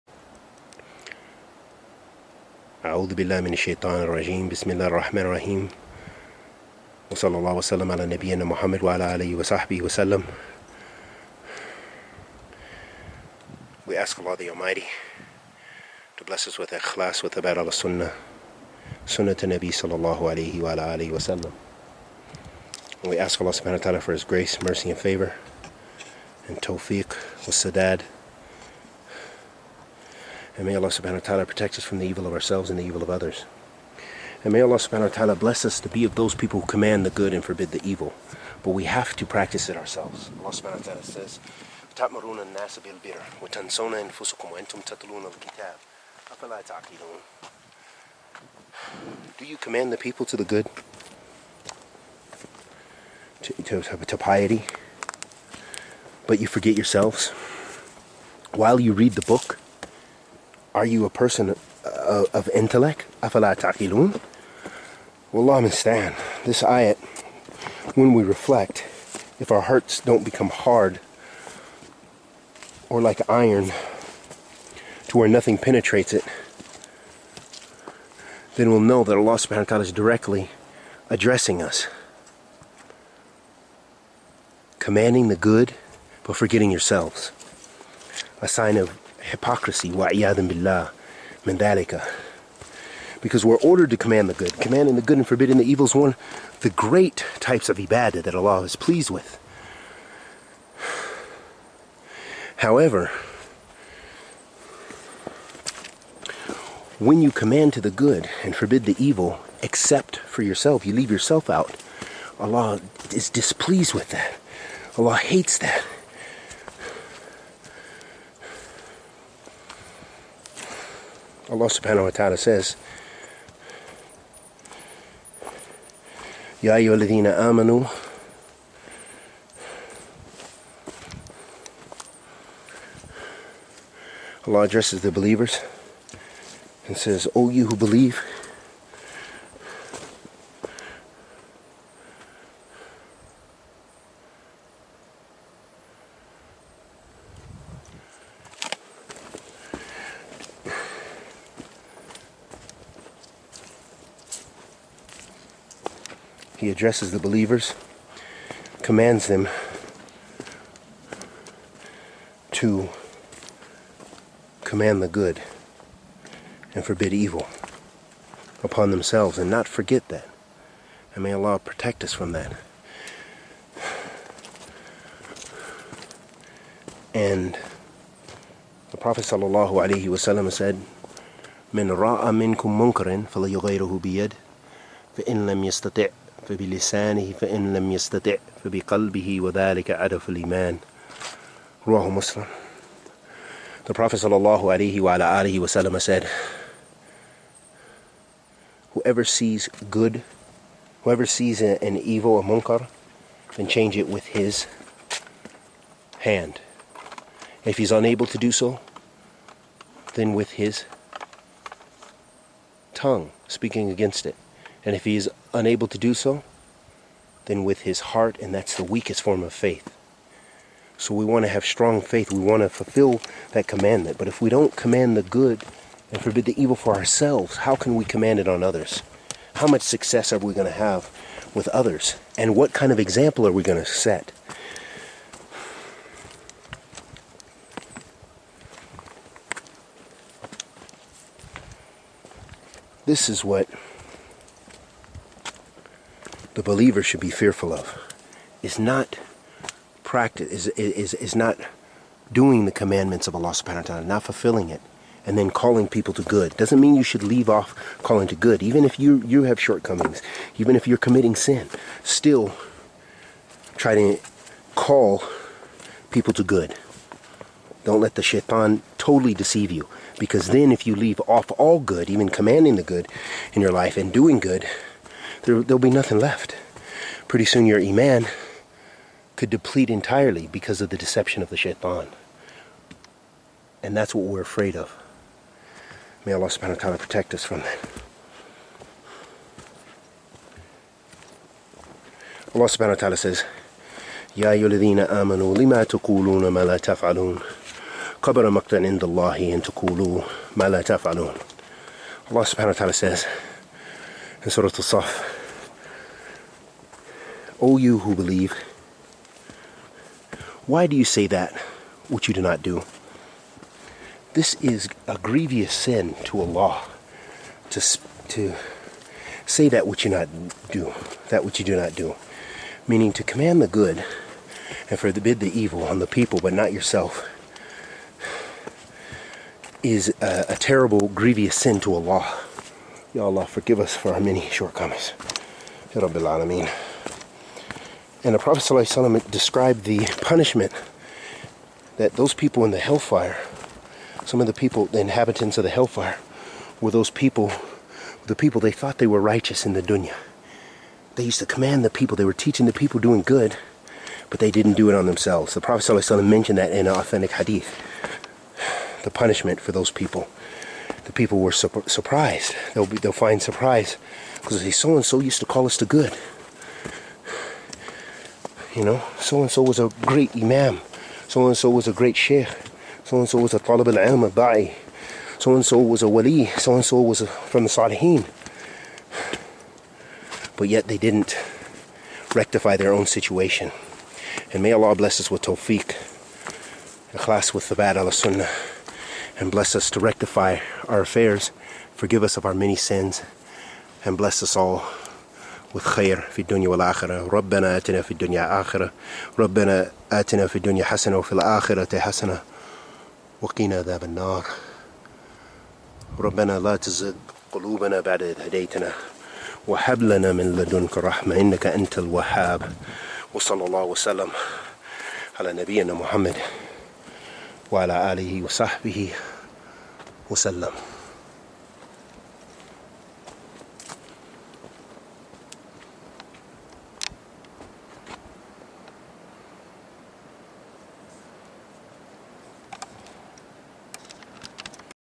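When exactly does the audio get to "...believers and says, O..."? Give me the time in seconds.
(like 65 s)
135 s.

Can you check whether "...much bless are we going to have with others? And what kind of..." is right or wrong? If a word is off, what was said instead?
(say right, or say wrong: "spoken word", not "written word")
wrong: "success", not "bless".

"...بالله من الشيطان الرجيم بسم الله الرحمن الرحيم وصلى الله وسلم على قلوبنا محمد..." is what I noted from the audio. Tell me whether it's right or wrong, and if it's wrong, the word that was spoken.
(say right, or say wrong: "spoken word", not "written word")
wrong: "نبينا", not "قلوبنا".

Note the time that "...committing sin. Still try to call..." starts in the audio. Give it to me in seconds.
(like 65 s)
260 s.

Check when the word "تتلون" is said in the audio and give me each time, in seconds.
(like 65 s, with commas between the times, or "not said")
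44 s.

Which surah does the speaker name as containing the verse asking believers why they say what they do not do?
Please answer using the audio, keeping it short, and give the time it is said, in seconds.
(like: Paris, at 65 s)
Surah Al-Saf, at 304 s.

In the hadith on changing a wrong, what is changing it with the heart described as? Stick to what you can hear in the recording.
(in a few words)
The weakest form of faith.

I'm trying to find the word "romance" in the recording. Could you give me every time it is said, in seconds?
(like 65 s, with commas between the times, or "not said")
not said.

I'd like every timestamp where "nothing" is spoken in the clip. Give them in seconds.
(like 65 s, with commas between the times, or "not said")
75 s, 275 s.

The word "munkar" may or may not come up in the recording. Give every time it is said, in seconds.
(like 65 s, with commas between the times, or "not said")
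202 s.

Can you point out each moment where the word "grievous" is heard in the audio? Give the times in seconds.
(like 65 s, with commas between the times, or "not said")
315 s, 331 s.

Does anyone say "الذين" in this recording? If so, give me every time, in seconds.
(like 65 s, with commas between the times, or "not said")
126 s, 294 s.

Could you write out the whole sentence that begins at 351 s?
They used to command the people, they were teaching the people doing good, but they didn't do it on themselves.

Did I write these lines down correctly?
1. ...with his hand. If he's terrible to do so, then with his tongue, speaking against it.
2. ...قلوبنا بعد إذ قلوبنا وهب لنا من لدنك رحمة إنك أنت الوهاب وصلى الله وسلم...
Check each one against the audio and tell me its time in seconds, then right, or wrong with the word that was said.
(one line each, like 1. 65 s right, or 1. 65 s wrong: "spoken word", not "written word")
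1. 204 s wrong: "unable", not "terrible"
2. 407 s wrong: "هديتنا", not "قلوبنا".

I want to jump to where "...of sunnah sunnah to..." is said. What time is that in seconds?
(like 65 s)
17 s.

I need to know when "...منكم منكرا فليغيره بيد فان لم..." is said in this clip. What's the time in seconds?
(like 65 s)
182 s.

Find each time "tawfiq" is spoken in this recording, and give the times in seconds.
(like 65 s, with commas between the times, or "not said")
26 s, 385 s.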